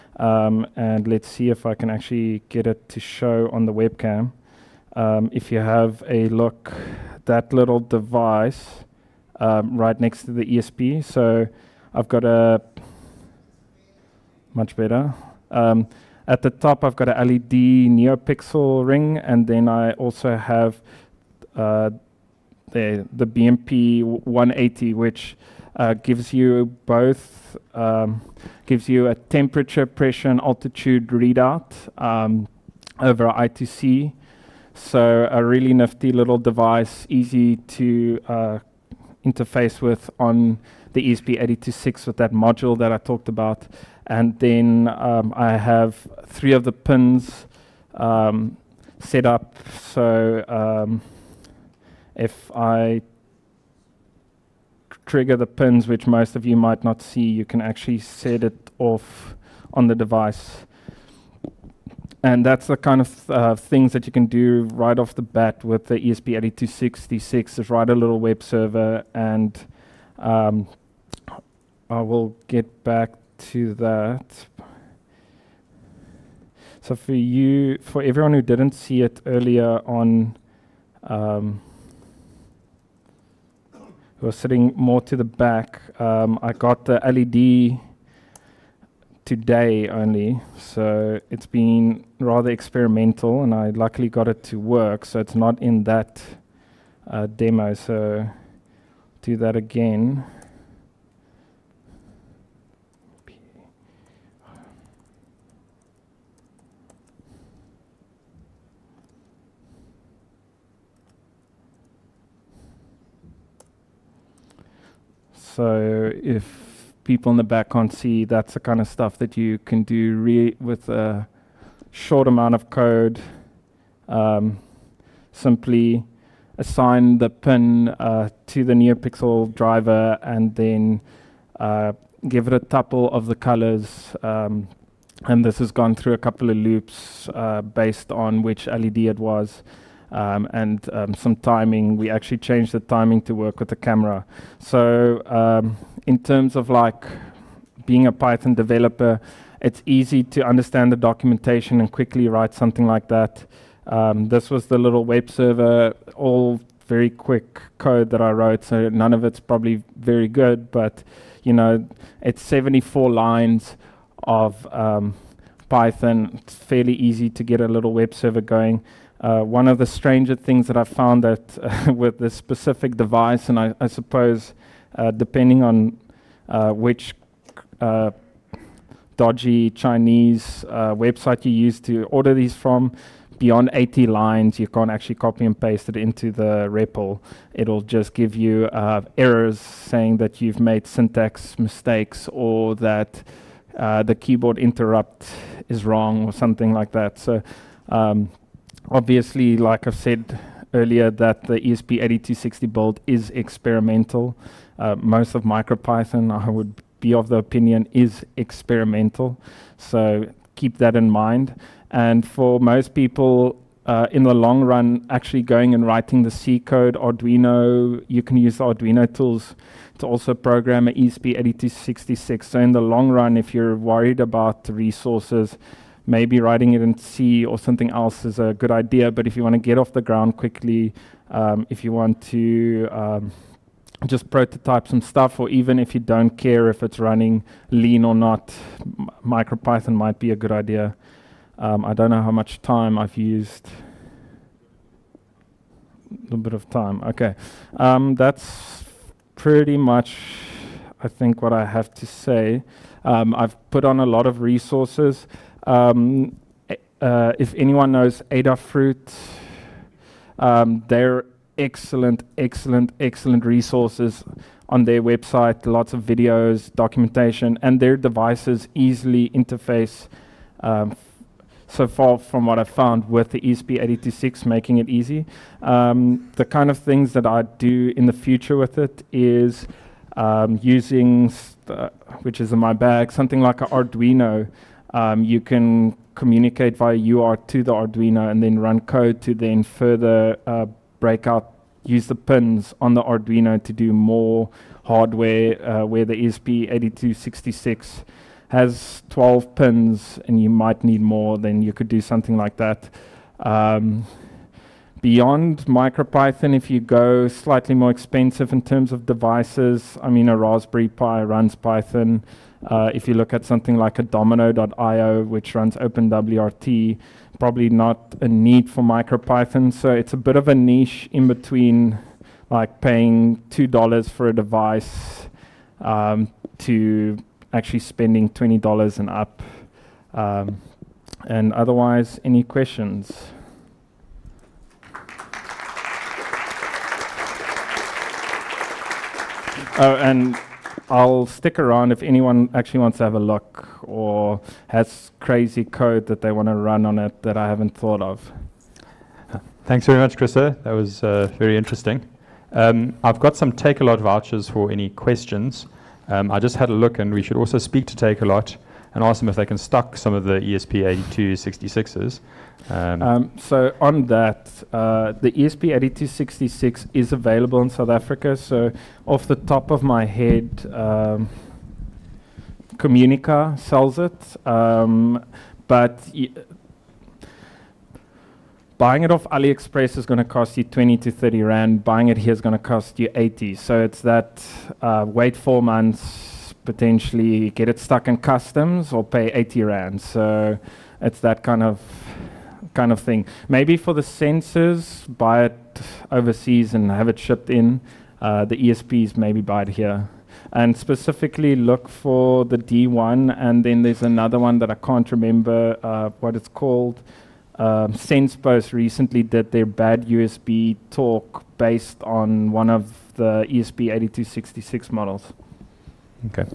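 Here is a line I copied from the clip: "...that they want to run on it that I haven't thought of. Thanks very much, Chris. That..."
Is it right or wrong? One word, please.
right.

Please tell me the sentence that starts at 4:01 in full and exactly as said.
Um, I don't know how much time I've used.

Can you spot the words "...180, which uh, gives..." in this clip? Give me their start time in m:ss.
0:24.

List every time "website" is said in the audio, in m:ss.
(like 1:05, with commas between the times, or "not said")
3:00, 4:25.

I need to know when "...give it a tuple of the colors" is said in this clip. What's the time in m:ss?
2:12.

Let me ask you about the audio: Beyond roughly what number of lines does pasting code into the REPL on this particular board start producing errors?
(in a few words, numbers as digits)
80.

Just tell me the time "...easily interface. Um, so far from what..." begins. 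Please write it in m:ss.
4:28.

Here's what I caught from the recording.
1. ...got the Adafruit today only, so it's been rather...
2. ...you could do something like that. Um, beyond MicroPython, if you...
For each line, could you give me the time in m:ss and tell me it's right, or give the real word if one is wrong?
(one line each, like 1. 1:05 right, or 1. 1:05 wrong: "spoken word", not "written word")
1. 1:26 wrong: "LED", not "Adafruit"
2. 5:01 right.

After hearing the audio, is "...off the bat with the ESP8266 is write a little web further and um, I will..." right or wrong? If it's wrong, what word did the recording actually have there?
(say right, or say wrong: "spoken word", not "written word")
wrong: "server", not "further".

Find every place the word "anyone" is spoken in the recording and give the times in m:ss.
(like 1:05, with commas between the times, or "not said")
4:17, 5:42.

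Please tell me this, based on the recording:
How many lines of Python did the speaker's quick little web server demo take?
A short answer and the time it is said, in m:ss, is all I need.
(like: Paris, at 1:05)
74, at 2:42.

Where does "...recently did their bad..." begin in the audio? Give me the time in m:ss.
6:48.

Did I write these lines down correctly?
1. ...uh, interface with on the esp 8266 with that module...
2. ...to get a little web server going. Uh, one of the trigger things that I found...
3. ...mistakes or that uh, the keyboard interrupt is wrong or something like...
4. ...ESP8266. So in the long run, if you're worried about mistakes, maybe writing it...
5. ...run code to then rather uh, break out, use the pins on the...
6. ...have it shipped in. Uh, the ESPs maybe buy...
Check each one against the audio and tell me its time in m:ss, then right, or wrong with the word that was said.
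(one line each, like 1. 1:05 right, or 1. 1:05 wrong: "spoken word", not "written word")
1. 0:38 right
2. 2:47 wrong: "stranger", not "trigger"
3. 3:11 right
4. 3:40 wrong: "resources", not "mistakes"
5. 4:48 wrong: "further", not "rather"
6. 6:36 right.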